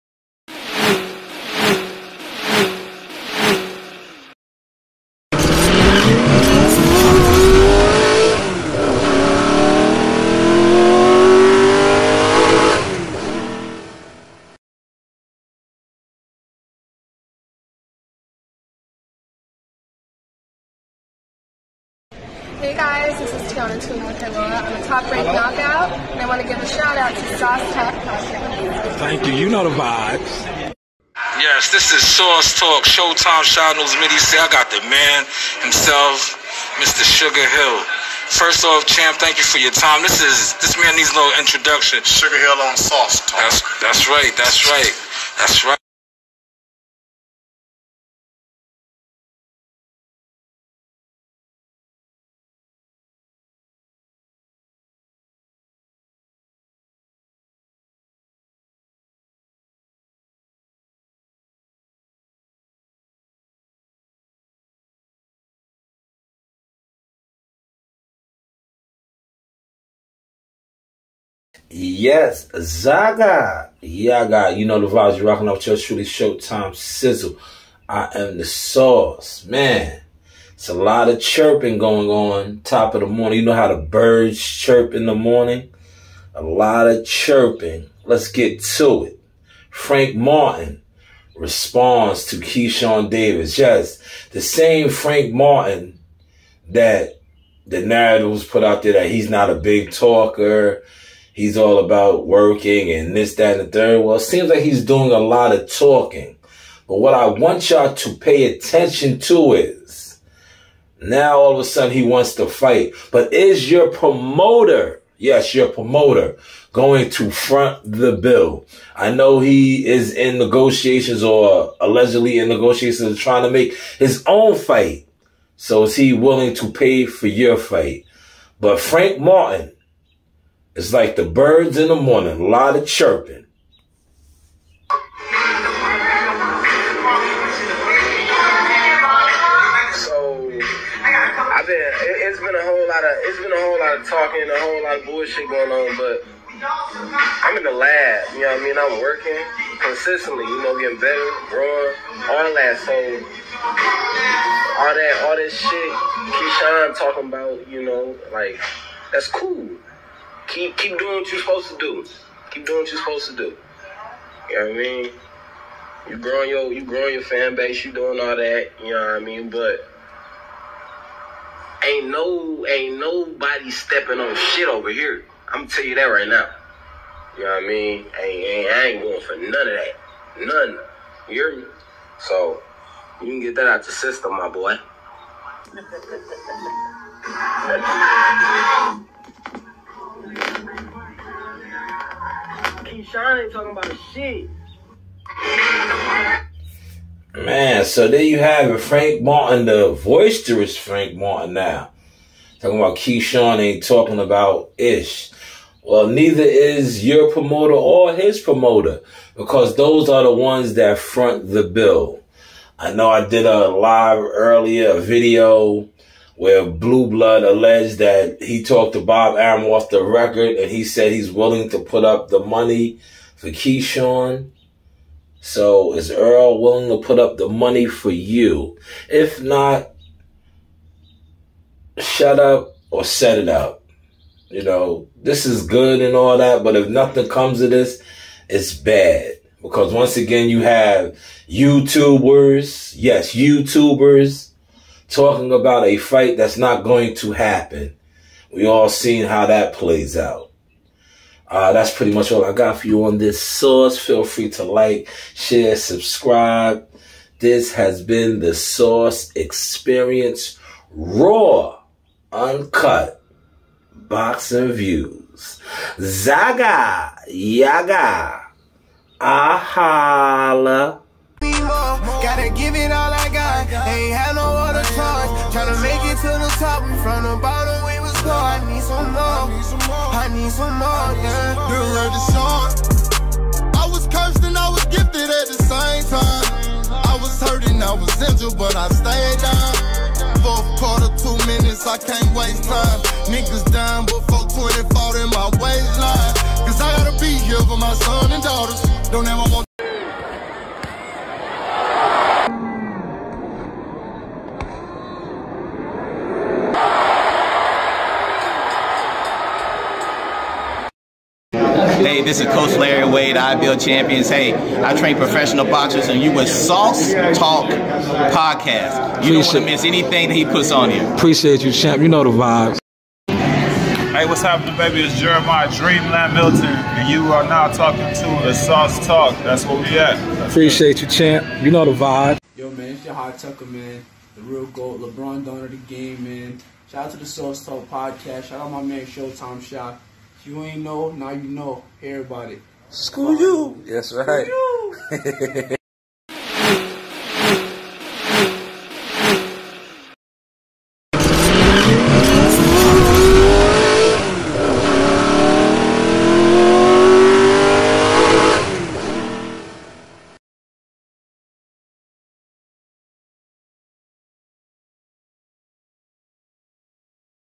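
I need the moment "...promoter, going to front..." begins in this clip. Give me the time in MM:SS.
01:55.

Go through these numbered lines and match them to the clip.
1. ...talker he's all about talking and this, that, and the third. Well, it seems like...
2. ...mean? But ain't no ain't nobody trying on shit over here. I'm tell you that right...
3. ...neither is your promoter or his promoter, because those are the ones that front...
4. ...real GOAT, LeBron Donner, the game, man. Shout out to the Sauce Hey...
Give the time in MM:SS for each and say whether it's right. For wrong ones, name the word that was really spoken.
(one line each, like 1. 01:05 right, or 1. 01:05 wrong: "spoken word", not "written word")
1. 01:39 wrong: "working", not "talking"
2. 02:49 wrong: "stepping", not "trying"
3. 03:26 right
4. 05:34 wrong: "Talk", not "Hey".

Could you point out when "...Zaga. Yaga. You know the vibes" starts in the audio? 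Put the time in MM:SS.
01:12.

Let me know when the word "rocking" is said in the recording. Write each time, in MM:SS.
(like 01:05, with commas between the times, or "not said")
01:15.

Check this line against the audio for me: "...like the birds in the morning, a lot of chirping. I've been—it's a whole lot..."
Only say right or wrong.
right.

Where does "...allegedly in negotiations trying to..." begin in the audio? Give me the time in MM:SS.
02:01.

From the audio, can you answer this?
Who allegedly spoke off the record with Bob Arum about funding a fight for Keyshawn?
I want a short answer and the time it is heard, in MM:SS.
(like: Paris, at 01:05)
Blue Blood, at 03:36.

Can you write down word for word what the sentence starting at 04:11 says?
Uh, that's pretty much all I got for you on this source.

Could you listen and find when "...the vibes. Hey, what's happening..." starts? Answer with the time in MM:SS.
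05:22.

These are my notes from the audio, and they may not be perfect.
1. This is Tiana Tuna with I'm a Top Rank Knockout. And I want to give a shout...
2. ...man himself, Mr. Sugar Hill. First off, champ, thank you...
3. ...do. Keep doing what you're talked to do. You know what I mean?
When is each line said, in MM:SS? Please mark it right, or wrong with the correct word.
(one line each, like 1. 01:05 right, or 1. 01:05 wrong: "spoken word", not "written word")
1. 00:23 right
2. 00:34 right
3. 02:41 wrong: "supposed", not "talked".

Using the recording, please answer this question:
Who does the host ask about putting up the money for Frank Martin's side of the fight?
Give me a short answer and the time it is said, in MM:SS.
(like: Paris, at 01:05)
Errol, at 03:46.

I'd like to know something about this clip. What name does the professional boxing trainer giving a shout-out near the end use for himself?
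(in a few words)
Larry Wade.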